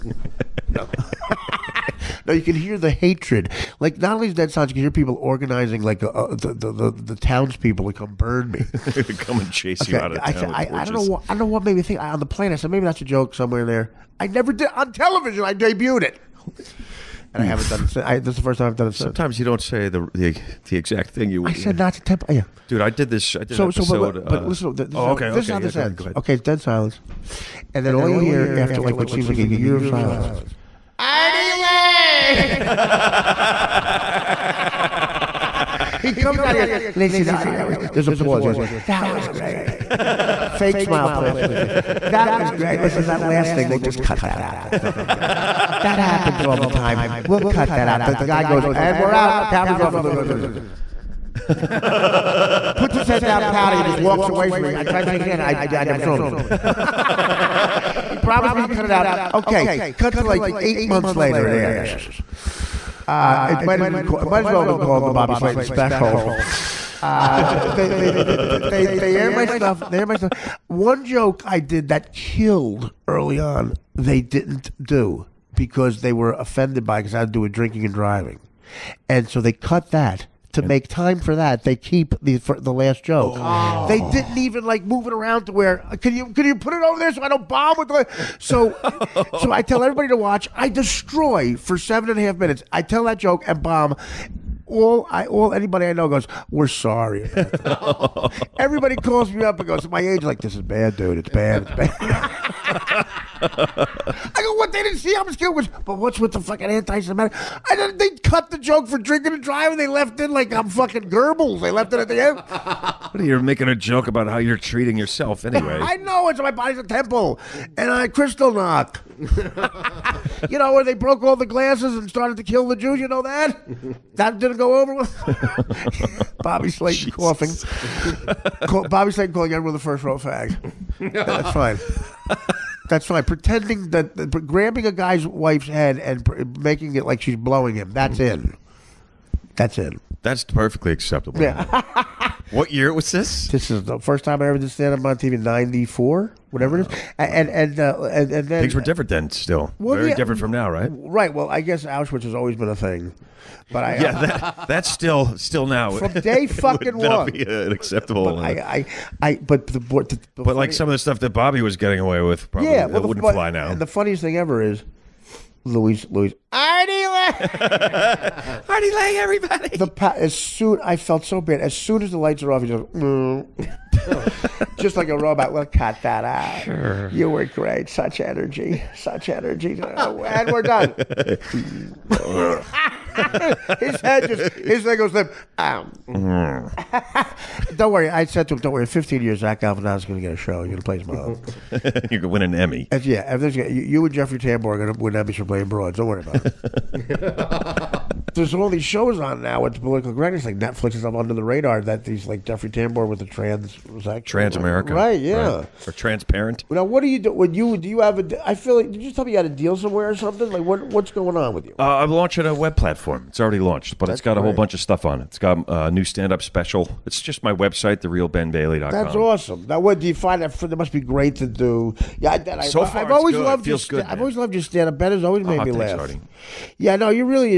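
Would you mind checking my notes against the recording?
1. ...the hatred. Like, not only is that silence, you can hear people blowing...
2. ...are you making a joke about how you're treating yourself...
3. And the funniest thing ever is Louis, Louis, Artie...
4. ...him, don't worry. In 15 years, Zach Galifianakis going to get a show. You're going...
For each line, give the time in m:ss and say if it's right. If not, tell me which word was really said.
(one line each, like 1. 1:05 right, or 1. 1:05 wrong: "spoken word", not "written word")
1. 0:02 wrong: "organizing", not "blowing"
2. 1:53 right
3. 2:43 right
4. 3:08 right.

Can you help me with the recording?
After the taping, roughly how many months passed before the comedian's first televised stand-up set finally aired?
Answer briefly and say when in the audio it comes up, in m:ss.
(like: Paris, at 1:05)
8 months, at 1:00.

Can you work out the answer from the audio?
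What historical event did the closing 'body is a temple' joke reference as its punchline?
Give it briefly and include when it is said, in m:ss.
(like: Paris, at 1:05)
Kristallnacht, at 1:58.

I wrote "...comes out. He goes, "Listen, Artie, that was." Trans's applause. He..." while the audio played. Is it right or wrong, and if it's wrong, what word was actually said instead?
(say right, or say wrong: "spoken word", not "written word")
wrong: "There", not "Trans".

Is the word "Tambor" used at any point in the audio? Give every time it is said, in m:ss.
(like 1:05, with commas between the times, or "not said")
3:14, 3:22.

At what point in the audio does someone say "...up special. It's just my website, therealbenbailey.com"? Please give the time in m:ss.
3:36.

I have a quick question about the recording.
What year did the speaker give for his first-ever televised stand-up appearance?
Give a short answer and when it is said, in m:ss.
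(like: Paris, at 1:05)
1994, at 2:25.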